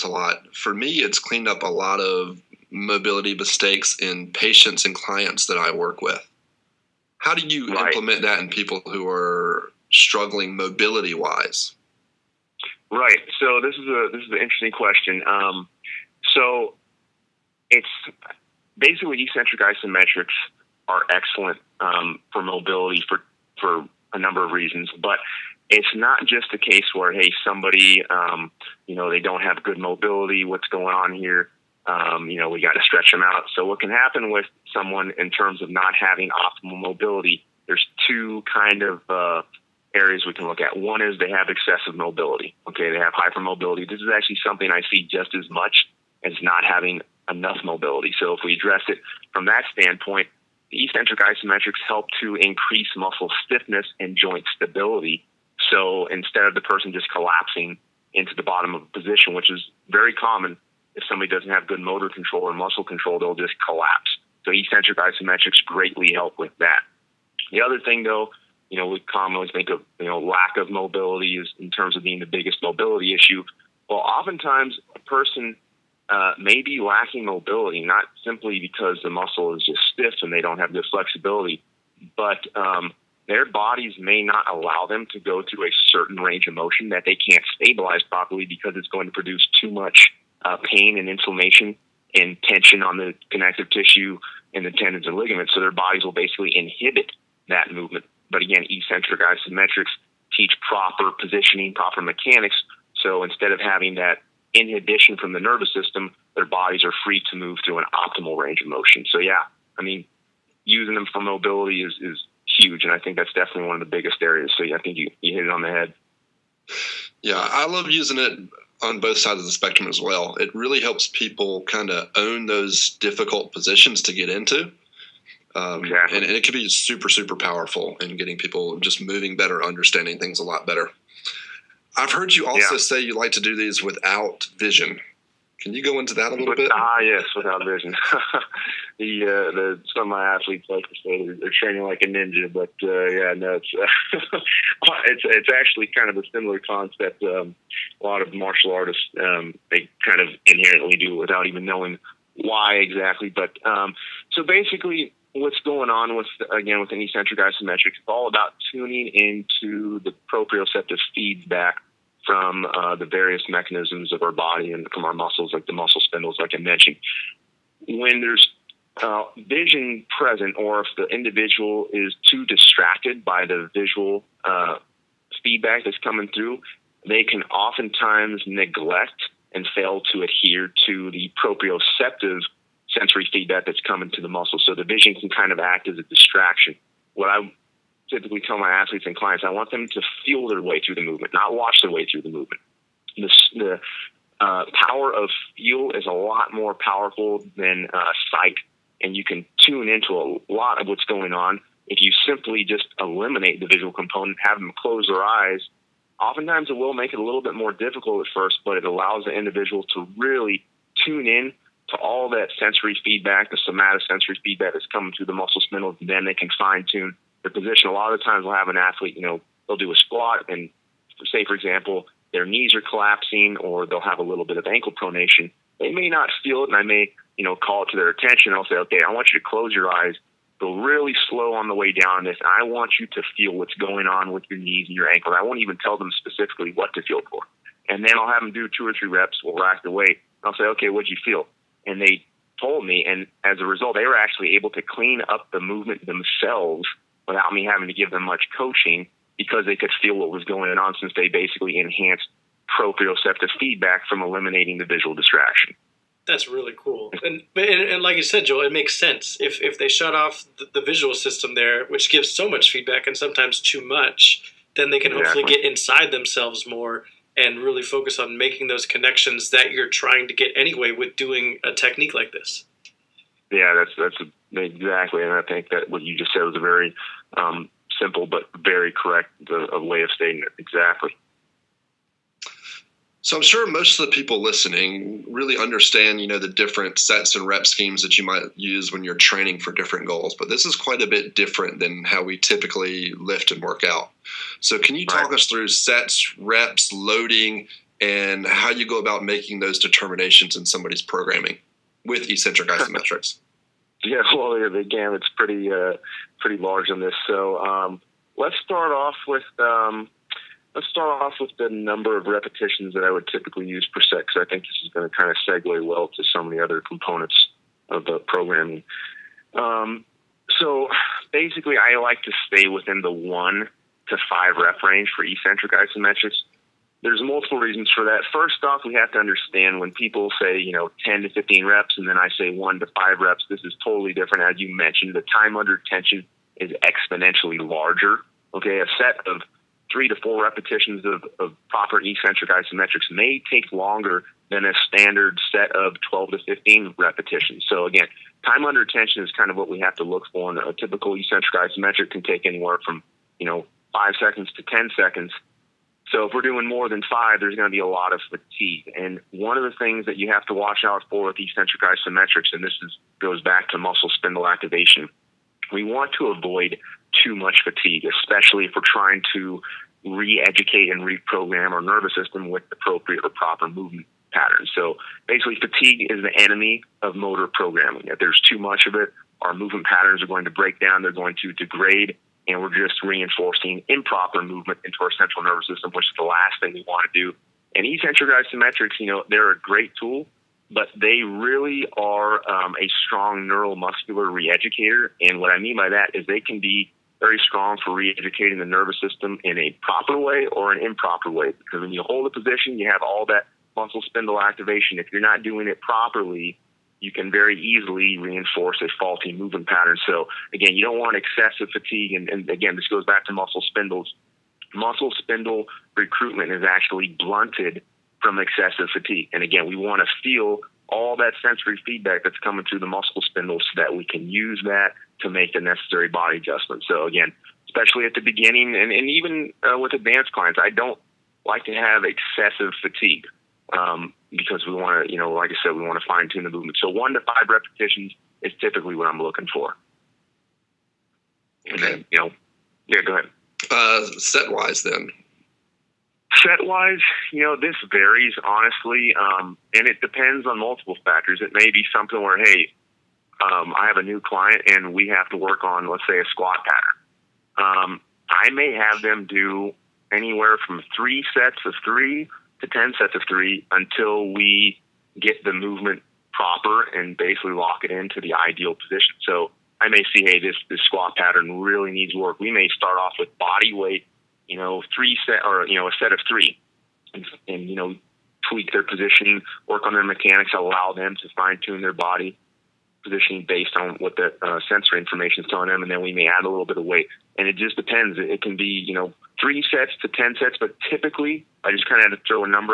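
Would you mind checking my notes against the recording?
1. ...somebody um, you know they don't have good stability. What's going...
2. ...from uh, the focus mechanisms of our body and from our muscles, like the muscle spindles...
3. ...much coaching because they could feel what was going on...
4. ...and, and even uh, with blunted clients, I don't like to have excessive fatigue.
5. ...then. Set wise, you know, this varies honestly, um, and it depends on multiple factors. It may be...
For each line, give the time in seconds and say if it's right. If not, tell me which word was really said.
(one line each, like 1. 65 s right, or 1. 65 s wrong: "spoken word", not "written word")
1. 27 s wrong: "mobility", not "stability"
2. 162 s wrong: "various", not "focus"
3. 248 s right
4. 428 s wrong: "advanced", not "blunted"
5. 444 s right.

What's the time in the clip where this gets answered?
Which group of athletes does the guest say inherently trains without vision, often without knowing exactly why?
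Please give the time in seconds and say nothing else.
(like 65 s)
148 s.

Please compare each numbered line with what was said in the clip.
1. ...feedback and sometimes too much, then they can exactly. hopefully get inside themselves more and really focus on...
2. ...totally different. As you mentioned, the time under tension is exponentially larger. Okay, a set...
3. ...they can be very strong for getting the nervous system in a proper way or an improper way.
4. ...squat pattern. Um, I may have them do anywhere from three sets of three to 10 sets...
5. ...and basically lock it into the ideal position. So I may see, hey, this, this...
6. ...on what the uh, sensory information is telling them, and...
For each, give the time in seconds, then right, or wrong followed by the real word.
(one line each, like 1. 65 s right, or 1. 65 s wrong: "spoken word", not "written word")
1. 262 s right
2. 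333 s right
3. 396 s wrong: "reeducating", not "getting"
4. 456 s right
5. 466 s right
6. 483 s right.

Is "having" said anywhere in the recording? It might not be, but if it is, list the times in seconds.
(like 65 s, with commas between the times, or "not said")
35 s, 46 s, 103 s, 247 s.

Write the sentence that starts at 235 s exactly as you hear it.
I won't even tell them specifically what to feel for.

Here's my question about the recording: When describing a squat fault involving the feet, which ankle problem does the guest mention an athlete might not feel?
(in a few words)
Ankle pronation.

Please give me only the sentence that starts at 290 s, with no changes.
But this is quite a bit different than how we typically lift and work out.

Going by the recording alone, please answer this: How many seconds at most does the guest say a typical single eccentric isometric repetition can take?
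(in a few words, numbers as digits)
10 seconds.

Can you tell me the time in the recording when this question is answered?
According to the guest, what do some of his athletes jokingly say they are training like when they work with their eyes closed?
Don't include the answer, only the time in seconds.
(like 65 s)
142 s.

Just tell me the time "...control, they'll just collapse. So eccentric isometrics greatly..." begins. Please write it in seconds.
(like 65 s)
62 s.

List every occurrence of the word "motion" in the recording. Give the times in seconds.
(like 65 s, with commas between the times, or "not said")
86 s, 108 s.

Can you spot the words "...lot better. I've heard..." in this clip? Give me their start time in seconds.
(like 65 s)
130 s.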